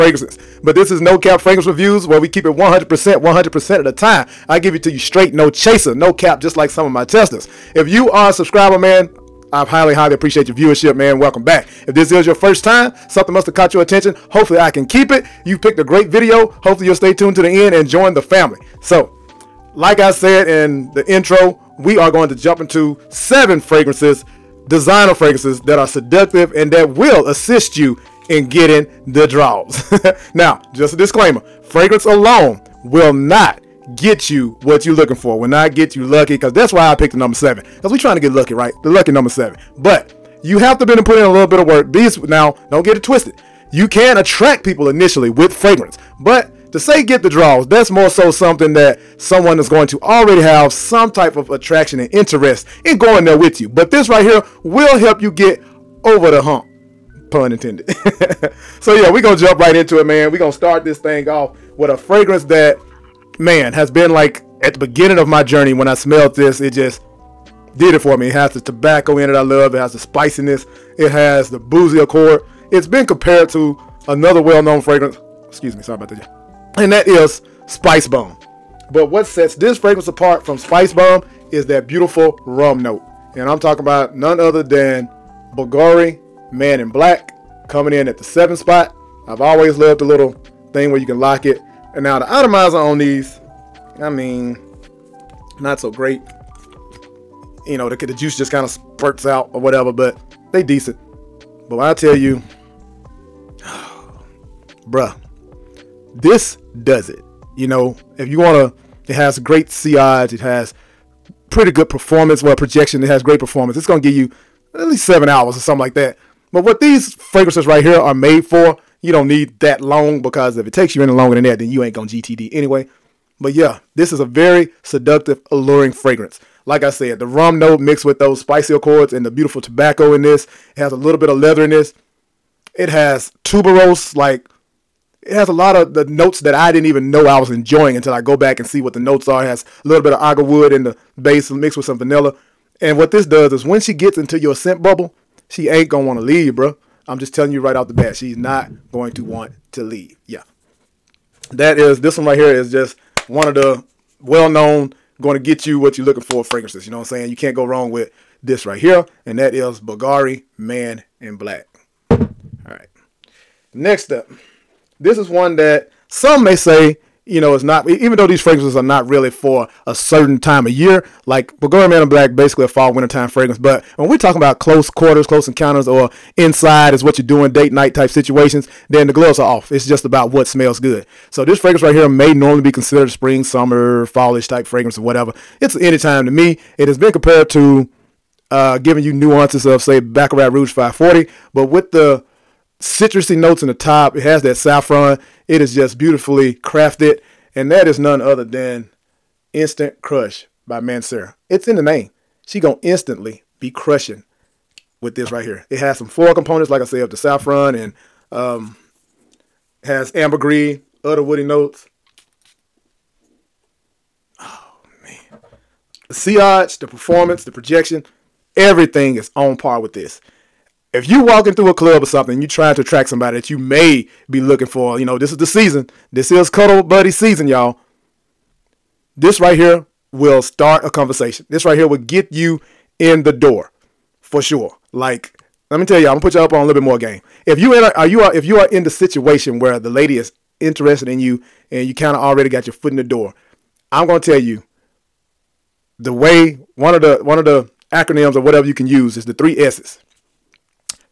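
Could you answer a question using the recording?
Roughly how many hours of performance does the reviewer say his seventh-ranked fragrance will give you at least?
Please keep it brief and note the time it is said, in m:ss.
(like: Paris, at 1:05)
7 hours, at 1:55.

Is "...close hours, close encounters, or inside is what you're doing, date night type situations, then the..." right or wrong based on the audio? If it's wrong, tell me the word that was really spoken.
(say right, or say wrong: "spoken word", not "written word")
wrong: "quarters", not "hours".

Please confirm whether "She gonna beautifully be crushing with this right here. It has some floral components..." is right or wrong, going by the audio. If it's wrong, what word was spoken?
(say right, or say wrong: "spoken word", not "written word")
wrong: "instantly", not "beautifully".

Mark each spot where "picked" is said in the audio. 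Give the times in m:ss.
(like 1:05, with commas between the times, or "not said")
0:15, 0:36.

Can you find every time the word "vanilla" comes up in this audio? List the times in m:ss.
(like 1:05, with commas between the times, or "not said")
2:21.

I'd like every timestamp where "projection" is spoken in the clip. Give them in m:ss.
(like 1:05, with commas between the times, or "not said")
1:52, 3:37.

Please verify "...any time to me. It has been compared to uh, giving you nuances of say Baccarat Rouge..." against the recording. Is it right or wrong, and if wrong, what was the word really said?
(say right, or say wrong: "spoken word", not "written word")
right.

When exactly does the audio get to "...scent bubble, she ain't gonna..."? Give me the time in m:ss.
2:24.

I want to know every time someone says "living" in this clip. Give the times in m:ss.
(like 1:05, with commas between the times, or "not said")
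not said.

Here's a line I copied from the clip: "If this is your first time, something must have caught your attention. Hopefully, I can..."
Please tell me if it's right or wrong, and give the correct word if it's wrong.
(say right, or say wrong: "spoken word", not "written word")
right.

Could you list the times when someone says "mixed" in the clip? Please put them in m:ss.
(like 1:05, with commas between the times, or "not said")
2:07, 2:21.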